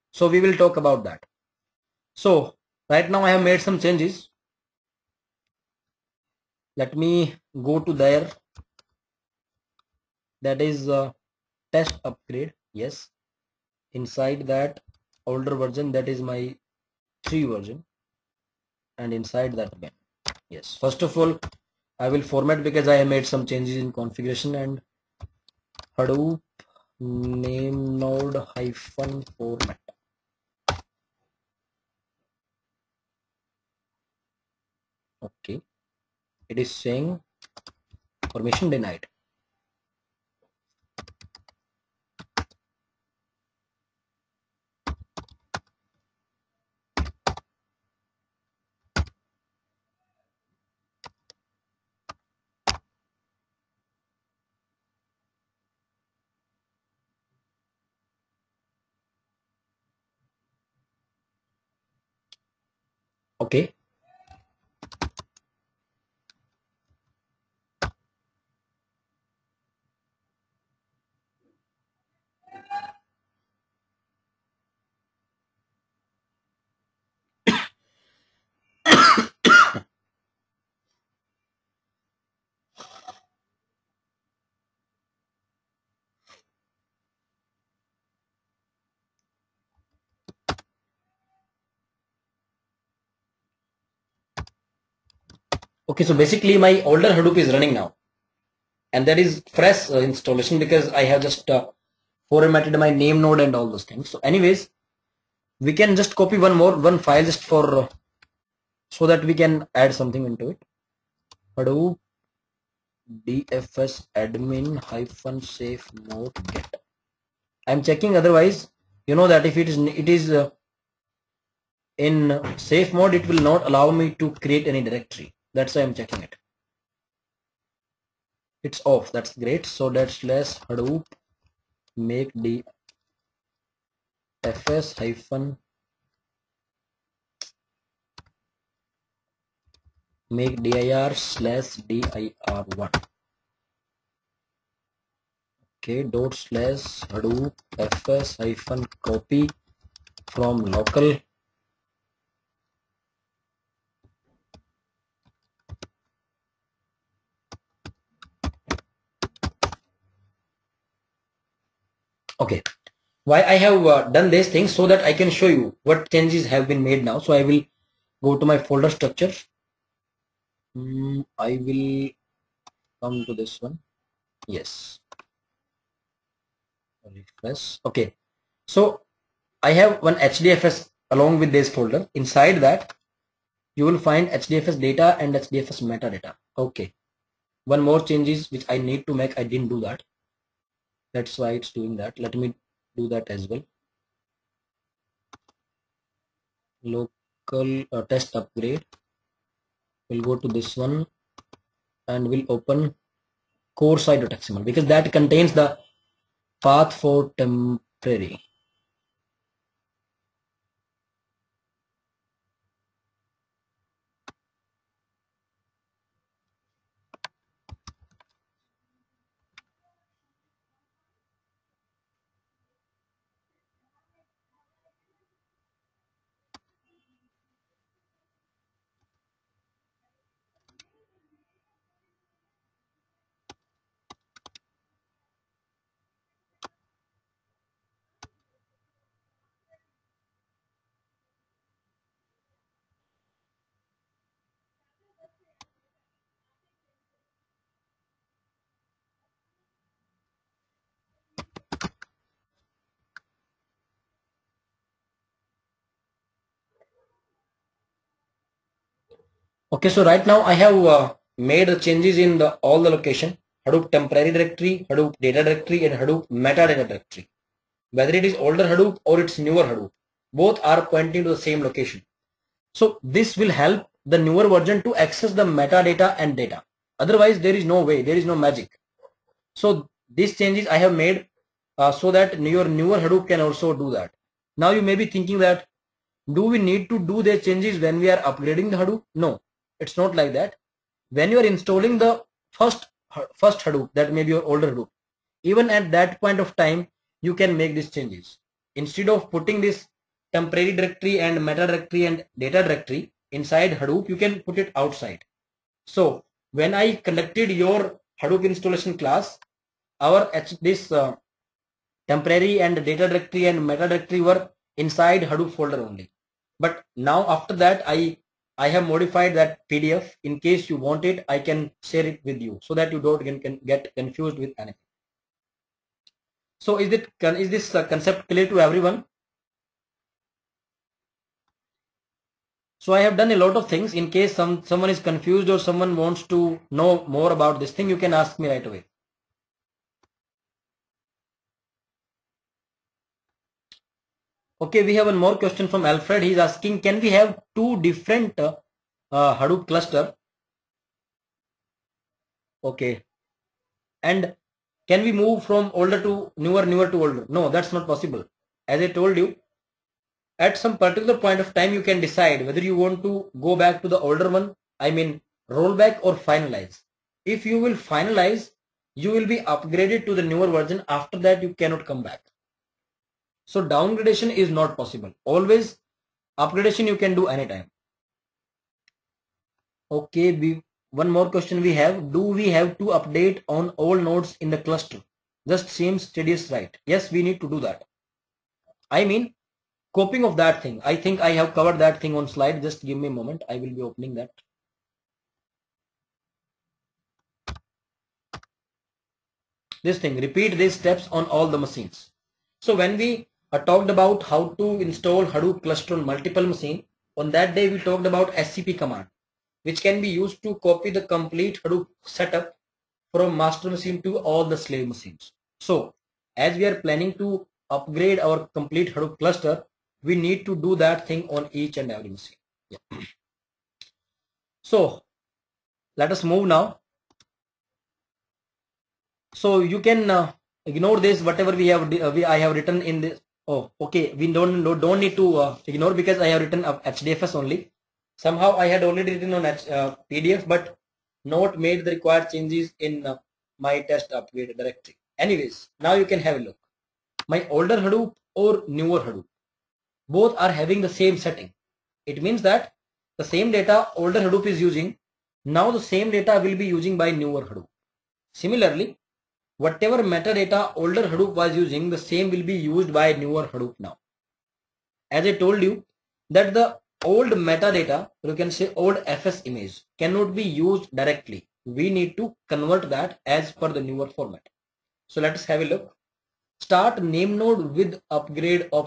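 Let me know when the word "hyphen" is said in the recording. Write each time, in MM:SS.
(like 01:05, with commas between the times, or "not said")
00:28, 01:54, 02:14, 02:28.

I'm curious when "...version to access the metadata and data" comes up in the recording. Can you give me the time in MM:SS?
04:34.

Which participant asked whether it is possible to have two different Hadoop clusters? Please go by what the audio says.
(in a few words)
Alfred.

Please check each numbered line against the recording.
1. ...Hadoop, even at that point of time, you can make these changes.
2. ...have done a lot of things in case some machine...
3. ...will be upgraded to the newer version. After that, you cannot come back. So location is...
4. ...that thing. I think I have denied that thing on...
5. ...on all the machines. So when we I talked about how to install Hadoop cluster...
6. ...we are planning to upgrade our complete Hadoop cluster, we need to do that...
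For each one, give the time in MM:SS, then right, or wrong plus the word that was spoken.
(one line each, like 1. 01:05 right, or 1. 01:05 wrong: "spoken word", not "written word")
1. 04:54 right
2. 05:33 wrong: "someone", not "machine"
3. 06:09 wrong: "downgradation", not "location"
4. 06:30 wrong: "covered", not "denied"
5. 06:41 right
6. 06:56 right.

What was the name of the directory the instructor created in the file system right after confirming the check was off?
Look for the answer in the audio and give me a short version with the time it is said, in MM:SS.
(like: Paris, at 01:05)
dir1, at 02:21.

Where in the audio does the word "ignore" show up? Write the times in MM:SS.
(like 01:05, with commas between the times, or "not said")
07:10, 07:15.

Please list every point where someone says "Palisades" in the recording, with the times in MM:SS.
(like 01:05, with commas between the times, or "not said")
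not said.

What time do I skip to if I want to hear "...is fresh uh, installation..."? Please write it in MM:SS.
01:39.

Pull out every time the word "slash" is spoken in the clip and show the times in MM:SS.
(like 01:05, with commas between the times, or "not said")
02:21, 02:26.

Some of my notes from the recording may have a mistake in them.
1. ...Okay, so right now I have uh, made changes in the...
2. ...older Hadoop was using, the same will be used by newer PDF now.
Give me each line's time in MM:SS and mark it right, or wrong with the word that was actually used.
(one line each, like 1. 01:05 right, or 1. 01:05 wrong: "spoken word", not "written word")
1. 04:19 right
2. 07:40 wrong: "Hadoop", not "PDF".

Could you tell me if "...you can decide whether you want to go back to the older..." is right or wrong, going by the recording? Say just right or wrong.
right.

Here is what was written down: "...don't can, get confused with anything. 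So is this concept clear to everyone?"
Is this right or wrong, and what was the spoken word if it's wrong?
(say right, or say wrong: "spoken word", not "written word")
right.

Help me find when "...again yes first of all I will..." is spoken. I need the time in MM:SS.
00:19.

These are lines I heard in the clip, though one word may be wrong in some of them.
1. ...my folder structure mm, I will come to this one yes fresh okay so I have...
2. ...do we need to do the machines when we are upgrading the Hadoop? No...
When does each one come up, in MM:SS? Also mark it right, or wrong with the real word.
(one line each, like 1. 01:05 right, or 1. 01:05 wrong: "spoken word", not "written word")
1. 02:48 wrong: "refresh", not "fresh"
2. 04:46 wrong: "changes", not "machines".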